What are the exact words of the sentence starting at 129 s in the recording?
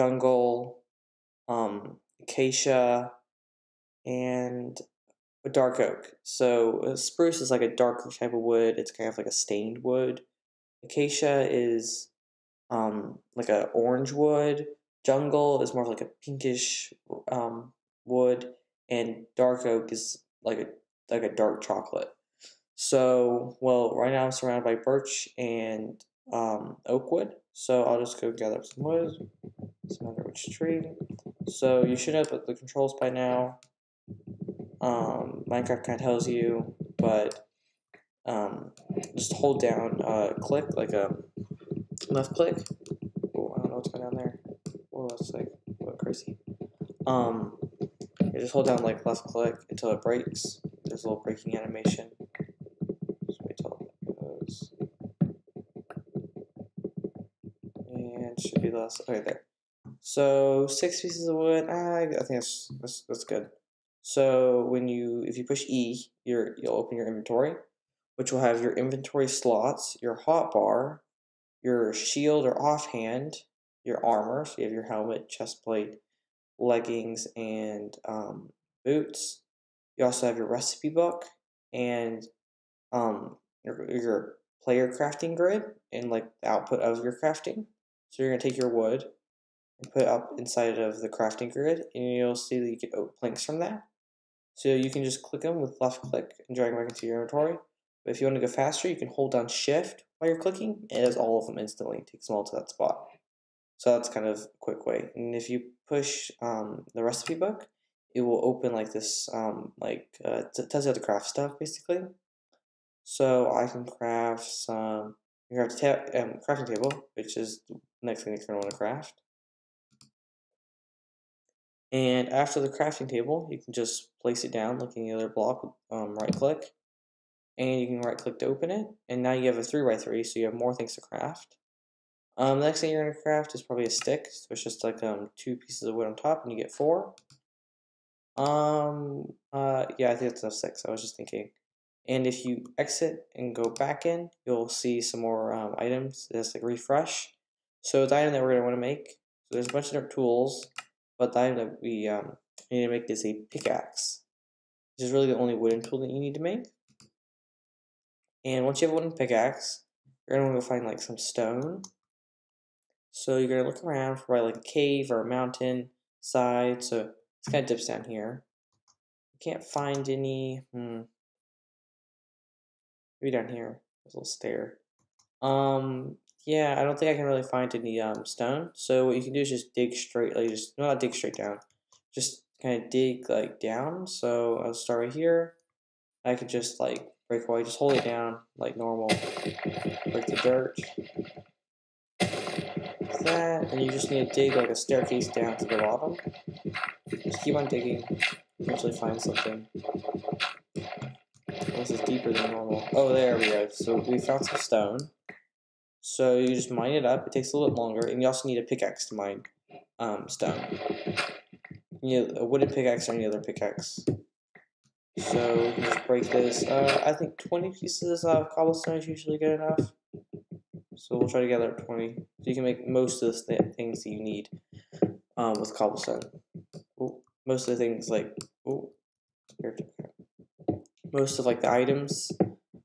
And now you have a three by three, so you have more things to craft.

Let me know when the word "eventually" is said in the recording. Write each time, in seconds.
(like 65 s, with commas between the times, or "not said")
198 s.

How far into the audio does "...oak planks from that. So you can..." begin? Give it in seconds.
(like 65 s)
92 s.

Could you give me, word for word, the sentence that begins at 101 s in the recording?
Take takes them all to that spot.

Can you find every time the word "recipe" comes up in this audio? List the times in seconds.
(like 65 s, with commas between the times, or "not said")
80 s, 107 s.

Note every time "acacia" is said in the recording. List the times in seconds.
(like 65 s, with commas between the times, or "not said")
2 s, 10 s.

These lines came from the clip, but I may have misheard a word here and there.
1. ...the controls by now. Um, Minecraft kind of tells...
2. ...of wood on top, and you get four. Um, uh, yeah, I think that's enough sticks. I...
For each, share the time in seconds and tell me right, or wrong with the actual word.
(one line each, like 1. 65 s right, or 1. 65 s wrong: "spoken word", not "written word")
1. 32 s right
2. 135 s right.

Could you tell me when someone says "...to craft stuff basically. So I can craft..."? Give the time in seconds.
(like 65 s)
110 s.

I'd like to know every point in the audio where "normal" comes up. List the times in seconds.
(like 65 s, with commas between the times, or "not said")
188 s, 202 s.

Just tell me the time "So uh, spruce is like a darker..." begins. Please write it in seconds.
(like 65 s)
6 s.